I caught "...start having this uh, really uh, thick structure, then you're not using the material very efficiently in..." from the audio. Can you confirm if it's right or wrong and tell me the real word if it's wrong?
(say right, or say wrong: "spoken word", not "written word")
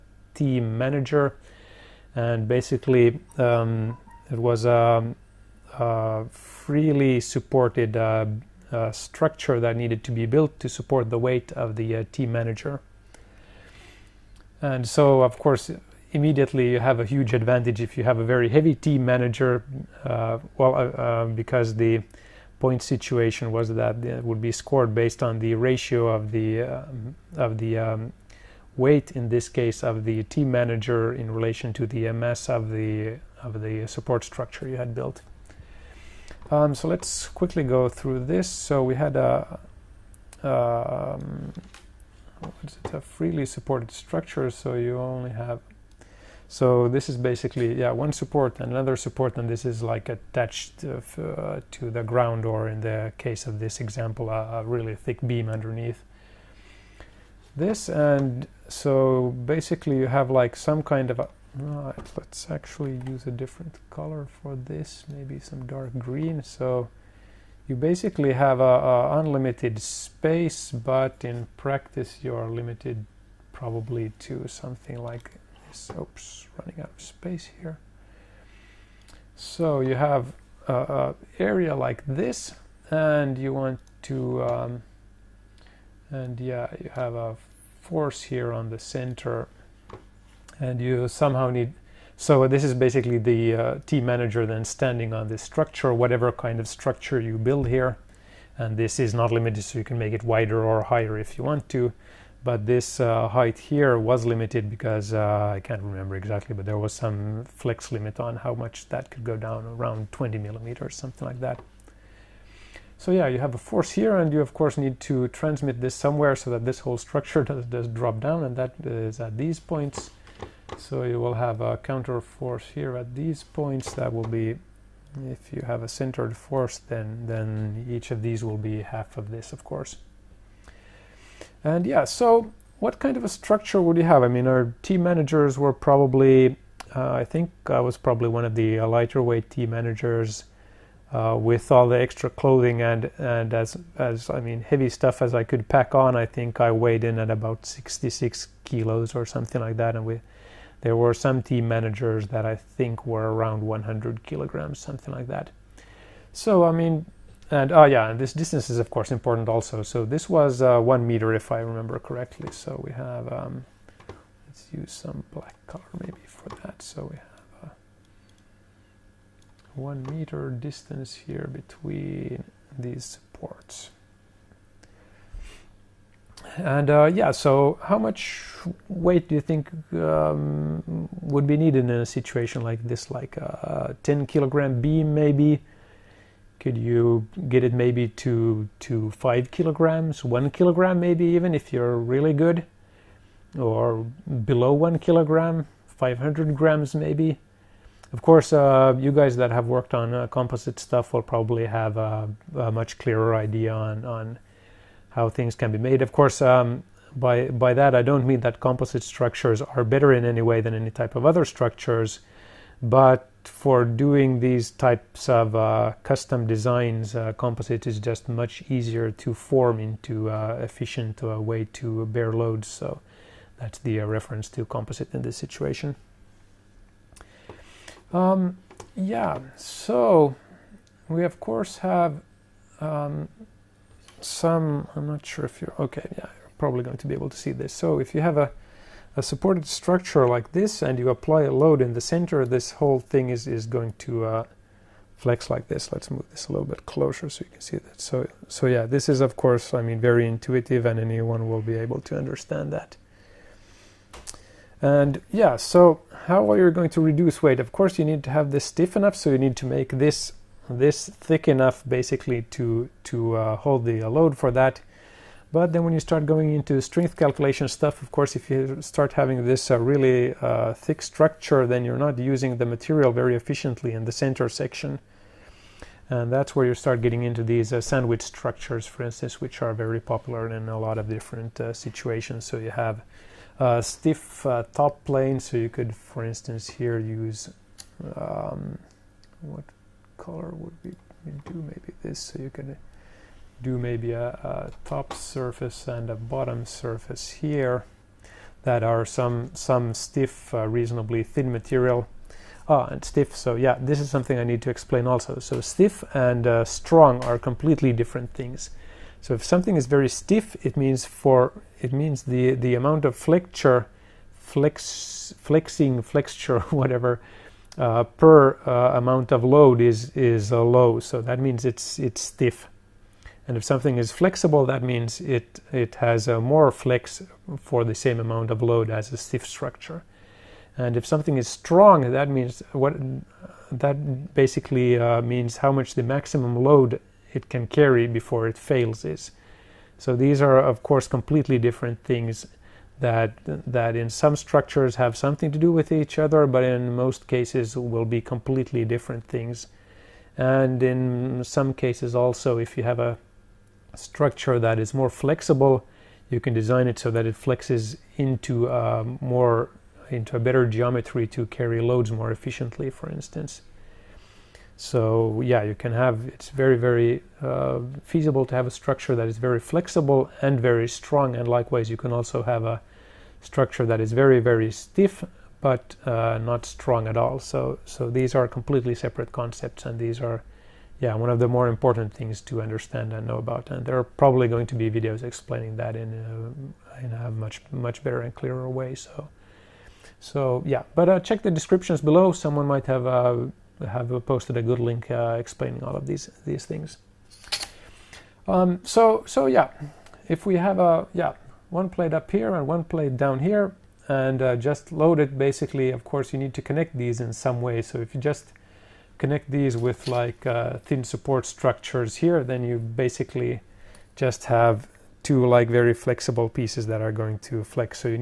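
right.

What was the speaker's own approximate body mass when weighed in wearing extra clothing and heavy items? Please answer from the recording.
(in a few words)
66 kilos.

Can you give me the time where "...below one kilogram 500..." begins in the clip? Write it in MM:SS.
03:14.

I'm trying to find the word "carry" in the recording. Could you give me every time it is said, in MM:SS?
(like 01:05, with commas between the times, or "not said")
05:37, 06:01.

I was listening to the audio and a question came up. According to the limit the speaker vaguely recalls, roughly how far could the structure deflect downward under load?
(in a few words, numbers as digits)
20 millimeters.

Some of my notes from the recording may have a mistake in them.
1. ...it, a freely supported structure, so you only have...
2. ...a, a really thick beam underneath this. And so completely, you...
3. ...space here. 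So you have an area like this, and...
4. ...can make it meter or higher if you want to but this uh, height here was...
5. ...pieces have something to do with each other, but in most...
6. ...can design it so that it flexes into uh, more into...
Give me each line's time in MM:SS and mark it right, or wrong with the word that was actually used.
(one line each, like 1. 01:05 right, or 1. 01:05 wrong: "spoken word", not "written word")
1. 00:42 right
2. 00:54 wrong: "basically", not "completely"
3. 01:17 right
4. 01:39 wrong: "wider", not "meter"
5. 05:44 wrong: "structures", not "pieces"
6. 05:56 right.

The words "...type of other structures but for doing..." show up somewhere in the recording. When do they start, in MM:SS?
03:30.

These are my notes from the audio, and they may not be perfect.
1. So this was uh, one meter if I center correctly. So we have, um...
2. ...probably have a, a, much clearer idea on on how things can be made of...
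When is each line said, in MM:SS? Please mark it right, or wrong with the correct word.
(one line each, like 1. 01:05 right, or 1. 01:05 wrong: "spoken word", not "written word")
1. 02:39 wrong: "remember", not "center"
2. 03:21 right.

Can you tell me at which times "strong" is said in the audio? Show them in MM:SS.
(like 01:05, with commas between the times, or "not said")
05:06, 05:31, 06:10, 06:16.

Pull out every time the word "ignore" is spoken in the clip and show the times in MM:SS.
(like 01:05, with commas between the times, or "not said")
not said.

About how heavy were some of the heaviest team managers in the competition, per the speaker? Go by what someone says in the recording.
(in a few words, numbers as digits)
100 kilograms.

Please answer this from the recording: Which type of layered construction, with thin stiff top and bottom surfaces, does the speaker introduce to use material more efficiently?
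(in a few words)
Sandwich structures.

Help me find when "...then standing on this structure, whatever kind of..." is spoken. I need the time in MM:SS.
01:34.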